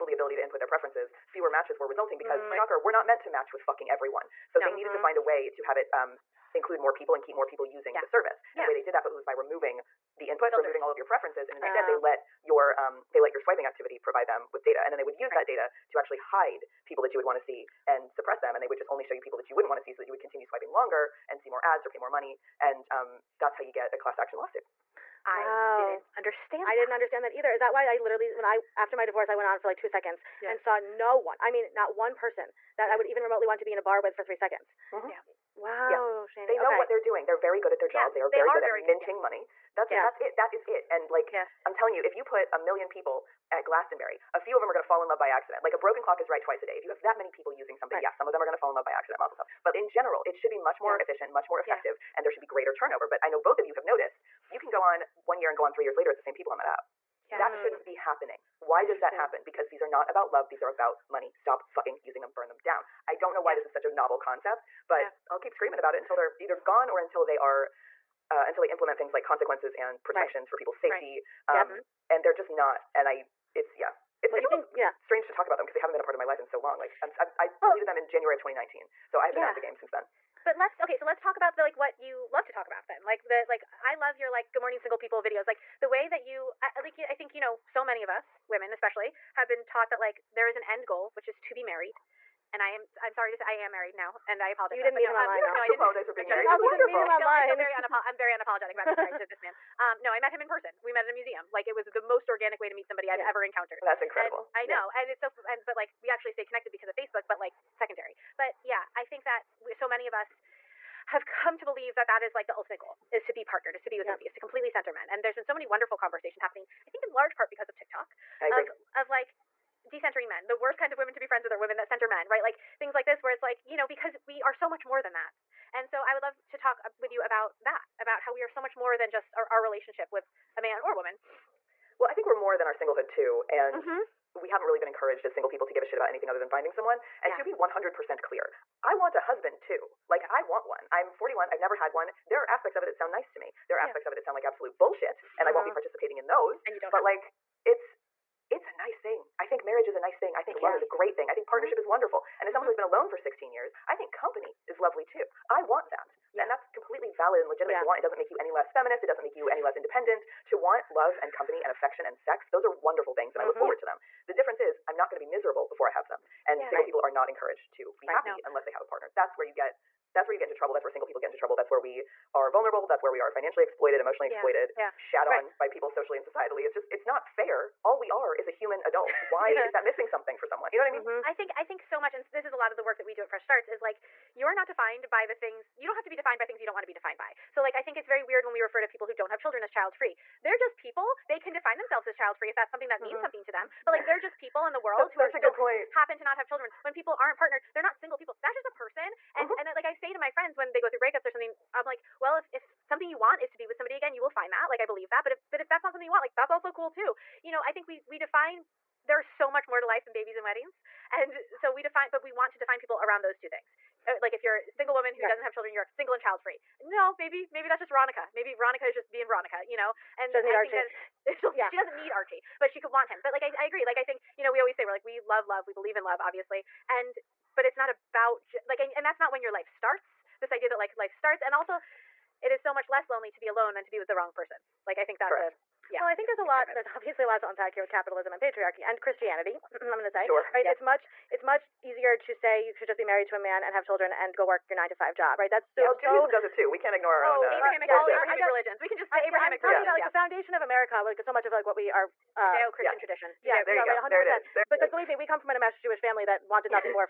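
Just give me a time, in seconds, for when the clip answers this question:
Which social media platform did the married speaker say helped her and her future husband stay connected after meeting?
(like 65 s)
106 s.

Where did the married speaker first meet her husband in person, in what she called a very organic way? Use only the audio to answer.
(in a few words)
A museum.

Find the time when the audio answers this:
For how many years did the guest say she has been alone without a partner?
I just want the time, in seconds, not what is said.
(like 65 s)
153 s.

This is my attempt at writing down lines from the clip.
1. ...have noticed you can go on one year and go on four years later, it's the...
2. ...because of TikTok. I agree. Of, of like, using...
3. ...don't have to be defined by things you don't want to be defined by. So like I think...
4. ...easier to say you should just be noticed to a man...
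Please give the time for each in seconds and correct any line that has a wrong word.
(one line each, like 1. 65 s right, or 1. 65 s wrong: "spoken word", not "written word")
1. 53 s wrong: "three", not "four"
2. 117 s wrong: "decentering", not "using"
3. 185 s right
4. 241 s wrong: "married", not "noticed".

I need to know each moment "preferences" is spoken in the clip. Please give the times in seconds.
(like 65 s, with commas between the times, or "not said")
0 s, 11 s.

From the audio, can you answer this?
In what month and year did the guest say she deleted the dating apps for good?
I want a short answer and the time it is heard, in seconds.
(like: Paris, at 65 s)
January 2019, at 78 s.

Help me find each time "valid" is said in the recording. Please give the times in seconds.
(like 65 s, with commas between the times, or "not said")
157 s.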